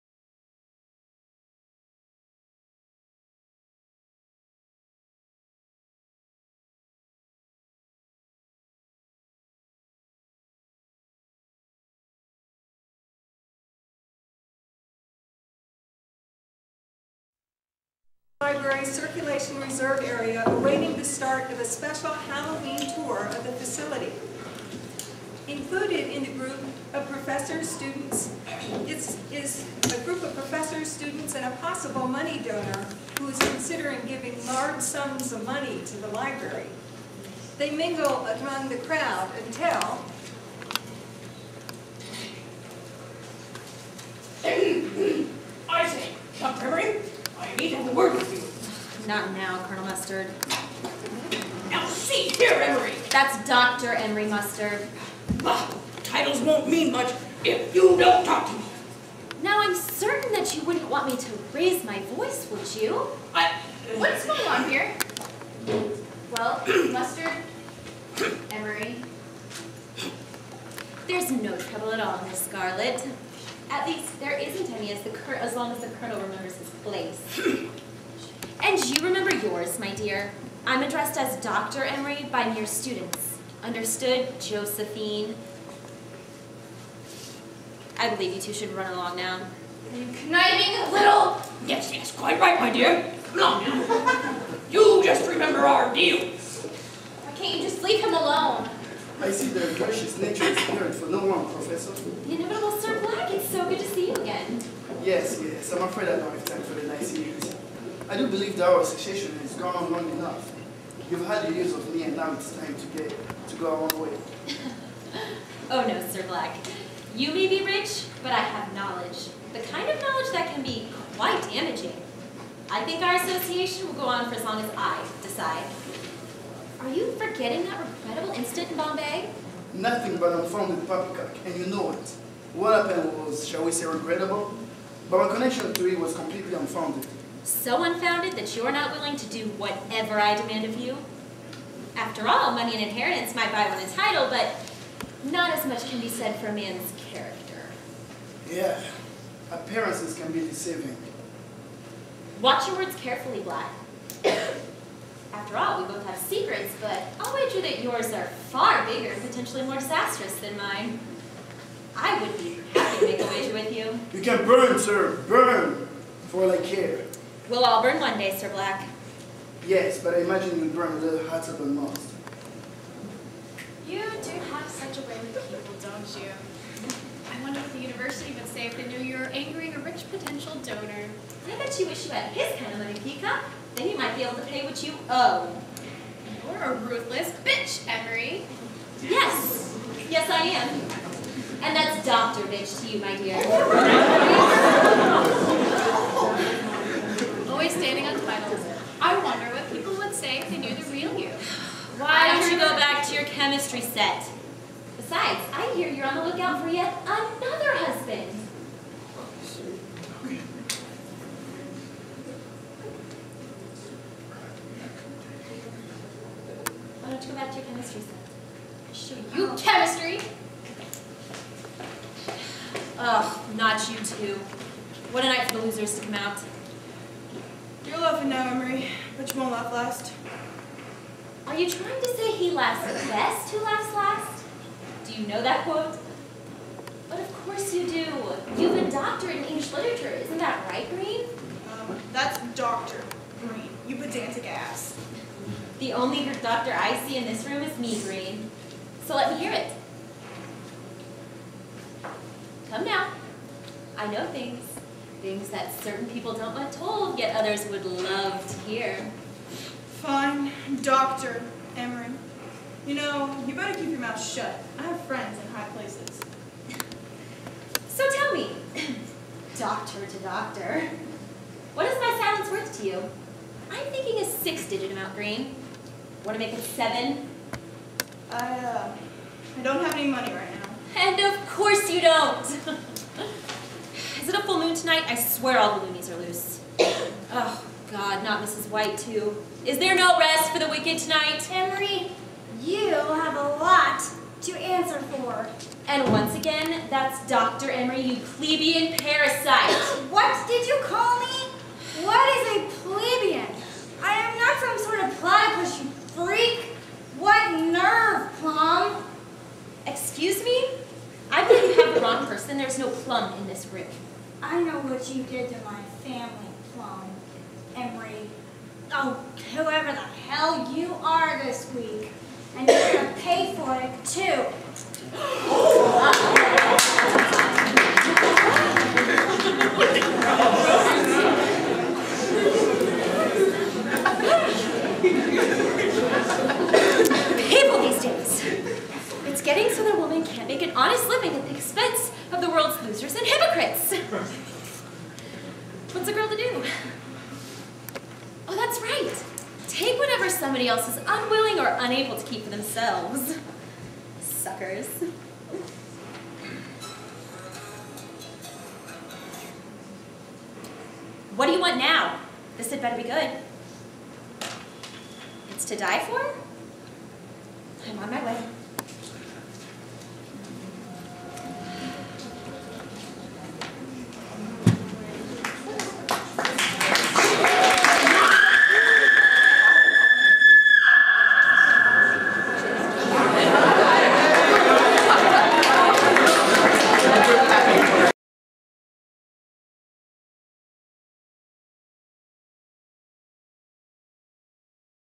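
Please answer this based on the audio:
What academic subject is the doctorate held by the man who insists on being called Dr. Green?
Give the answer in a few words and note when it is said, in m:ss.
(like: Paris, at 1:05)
English literature, at 3:59.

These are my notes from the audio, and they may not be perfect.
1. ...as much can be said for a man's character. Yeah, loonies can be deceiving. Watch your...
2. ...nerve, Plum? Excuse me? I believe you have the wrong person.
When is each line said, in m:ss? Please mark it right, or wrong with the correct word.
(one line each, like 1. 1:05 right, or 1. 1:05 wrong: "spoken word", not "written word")
1. 2:25 wrong: "appearances", not "loonies"
2. 5:07 right.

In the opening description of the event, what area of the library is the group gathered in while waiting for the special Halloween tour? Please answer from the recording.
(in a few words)
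Library Circulation Reserve Area.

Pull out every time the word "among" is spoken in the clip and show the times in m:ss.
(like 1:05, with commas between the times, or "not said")
0:38.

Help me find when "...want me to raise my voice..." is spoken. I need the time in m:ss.
1:00.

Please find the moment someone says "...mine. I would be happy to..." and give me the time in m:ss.
2:40.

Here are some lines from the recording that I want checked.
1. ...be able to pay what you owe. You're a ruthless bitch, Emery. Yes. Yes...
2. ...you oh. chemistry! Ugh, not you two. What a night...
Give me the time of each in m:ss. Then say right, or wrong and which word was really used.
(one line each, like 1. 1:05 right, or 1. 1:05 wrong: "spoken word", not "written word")
1. 3:04 right
2. 3:39 right.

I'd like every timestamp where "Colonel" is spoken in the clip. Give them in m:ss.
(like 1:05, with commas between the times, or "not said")
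0:49, 1:15.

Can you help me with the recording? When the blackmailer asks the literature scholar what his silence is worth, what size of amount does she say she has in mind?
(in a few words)
six-digit amount.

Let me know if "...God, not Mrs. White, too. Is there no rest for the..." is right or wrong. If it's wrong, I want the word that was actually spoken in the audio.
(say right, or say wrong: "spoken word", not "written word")
right.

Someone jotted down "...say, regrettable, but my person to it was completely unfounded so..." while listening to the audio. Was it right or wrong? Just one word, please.
wrong.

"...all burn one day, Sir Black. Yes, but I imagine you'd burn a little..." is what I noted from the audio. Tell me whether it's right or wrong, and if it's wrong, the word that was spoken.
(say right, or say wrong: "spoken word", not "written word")
right.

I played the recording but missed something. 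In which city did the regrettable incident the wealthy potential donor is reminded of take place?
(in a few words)
Bombay.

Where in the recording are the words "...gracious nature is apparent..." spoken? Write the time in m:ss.
1:39.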